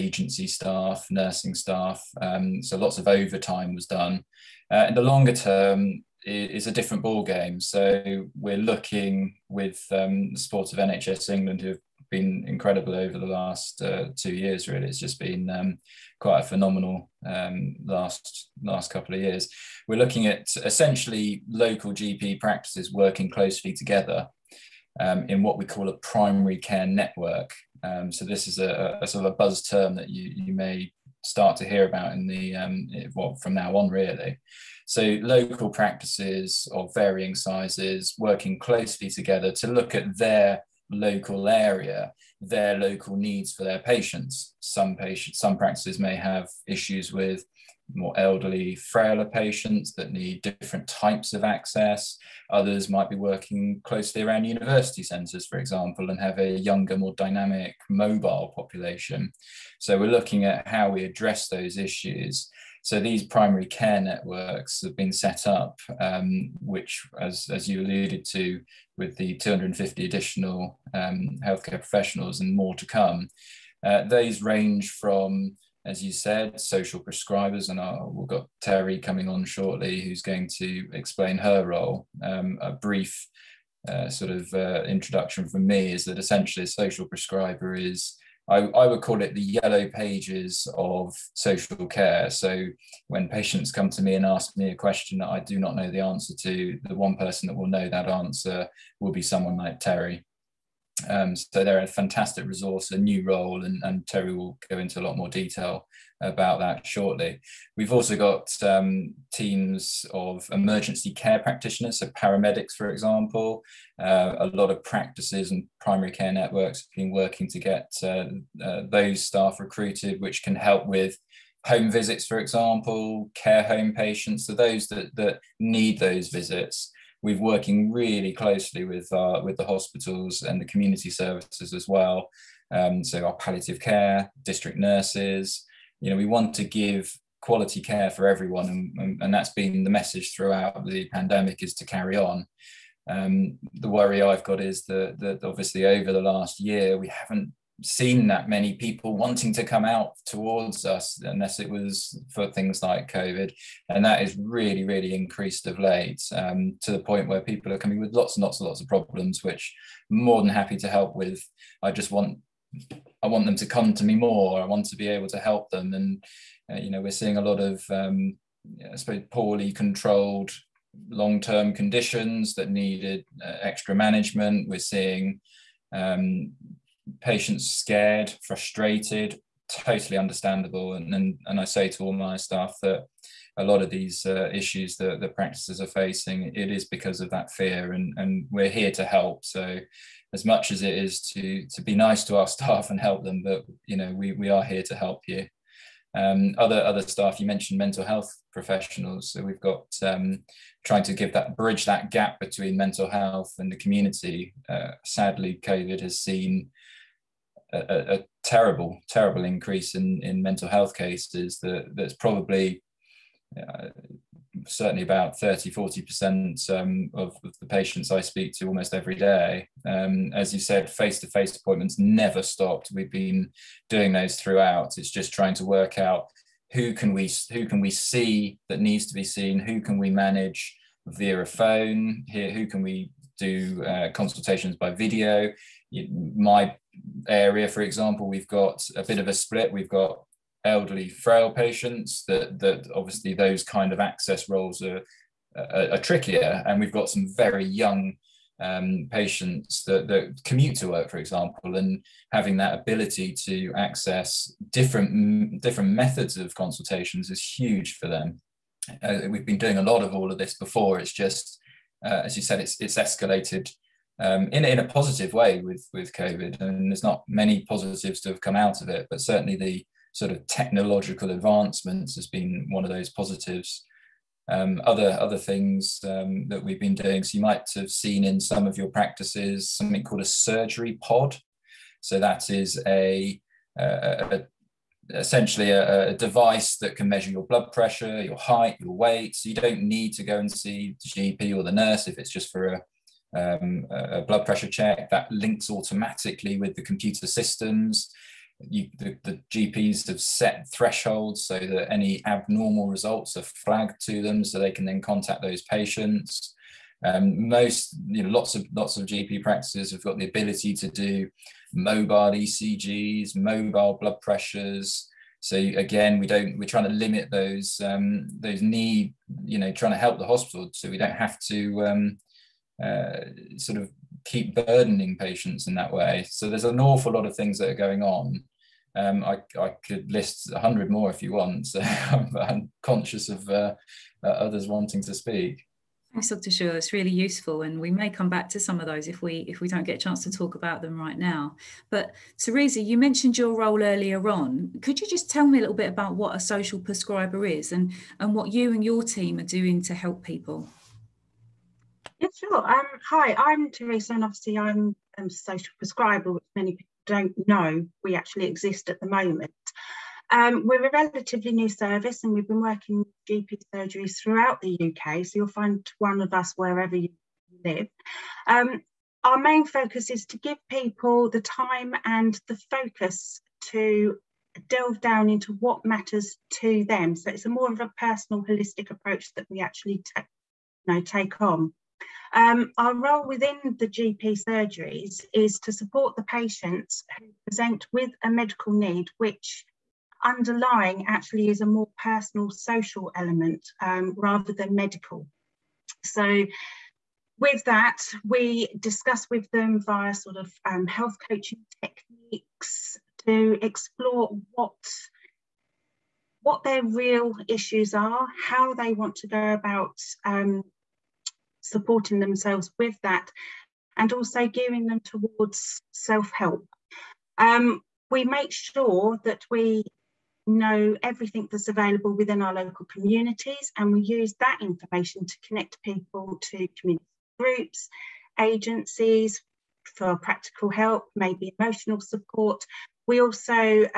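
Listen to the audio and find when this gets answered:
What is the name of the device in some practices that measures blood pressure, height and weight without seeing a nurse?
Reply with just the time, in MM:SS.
04:40.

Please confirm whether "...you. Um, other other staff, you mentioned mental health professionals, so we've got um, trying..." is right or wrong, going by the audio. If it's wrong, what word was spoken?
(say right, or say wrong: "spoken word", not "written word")
right.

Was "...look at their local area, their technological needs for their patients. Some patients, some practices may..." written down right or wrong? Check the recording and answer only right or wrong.
wrong.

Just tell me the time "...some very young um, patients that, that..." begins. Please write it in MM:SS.
04:07.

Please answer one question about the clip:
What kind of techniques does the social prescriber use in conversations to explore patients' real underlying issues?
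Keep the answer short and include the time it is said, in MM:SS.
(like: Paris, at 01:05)
health coaching, at 06:40.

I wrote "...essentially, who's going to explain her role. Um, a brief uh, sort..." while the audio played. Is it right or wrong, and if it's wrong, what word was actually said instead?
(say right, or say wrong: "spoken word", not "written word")
wrong: "shortly", not "essentially".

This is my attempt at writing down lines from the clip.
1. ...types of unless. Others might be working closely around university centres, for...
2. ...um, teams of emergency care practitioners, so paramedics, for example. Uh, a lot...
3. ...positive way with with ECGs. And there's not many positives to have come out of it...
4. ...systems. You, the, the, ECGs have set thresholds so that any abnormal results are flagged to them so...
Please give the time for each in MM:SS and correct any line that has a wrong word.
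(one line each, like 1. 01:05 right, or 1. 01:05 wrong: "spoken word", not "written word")
1. 00:50 wrong: "access", not "unless"
2. 01:48 right
3. 04:24 wrong: "COVID", not "ECGs"
4. 04:57 wrong: "GPs", not "ECGs".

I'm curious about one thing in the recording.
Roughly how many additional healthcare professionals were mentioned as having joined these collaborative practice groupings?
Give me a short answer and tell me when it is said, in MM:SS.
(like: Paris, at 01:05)
250, at 01:09.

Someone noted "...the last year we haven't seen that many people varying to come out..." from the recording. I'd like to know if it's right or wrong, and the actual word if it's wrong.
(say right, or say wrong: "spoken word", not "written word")
wrong: "wanting", not "varying".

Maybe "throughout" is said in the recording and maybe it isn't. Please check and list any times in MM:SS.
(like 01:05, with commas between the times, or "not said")
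02:20, 03:44, 06:04.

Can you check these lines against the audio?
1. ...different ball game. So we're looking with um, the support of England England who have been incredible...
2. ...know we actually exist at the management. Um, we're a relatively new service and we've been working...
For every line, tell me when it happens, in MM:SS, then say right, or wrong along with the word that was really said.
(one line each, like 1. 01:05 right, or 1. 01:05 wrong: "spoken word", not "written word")
1. 00:06 wrong: "NHS", not "England"
2. 05:57 wrong: "moment", not "management".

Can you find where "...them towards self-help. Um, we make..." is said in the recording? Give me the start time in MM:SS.
06:54.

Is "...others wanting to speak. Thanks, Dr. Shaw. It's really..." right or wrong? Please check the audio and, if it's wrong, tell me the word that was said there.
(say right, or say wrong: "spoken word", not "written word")
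right.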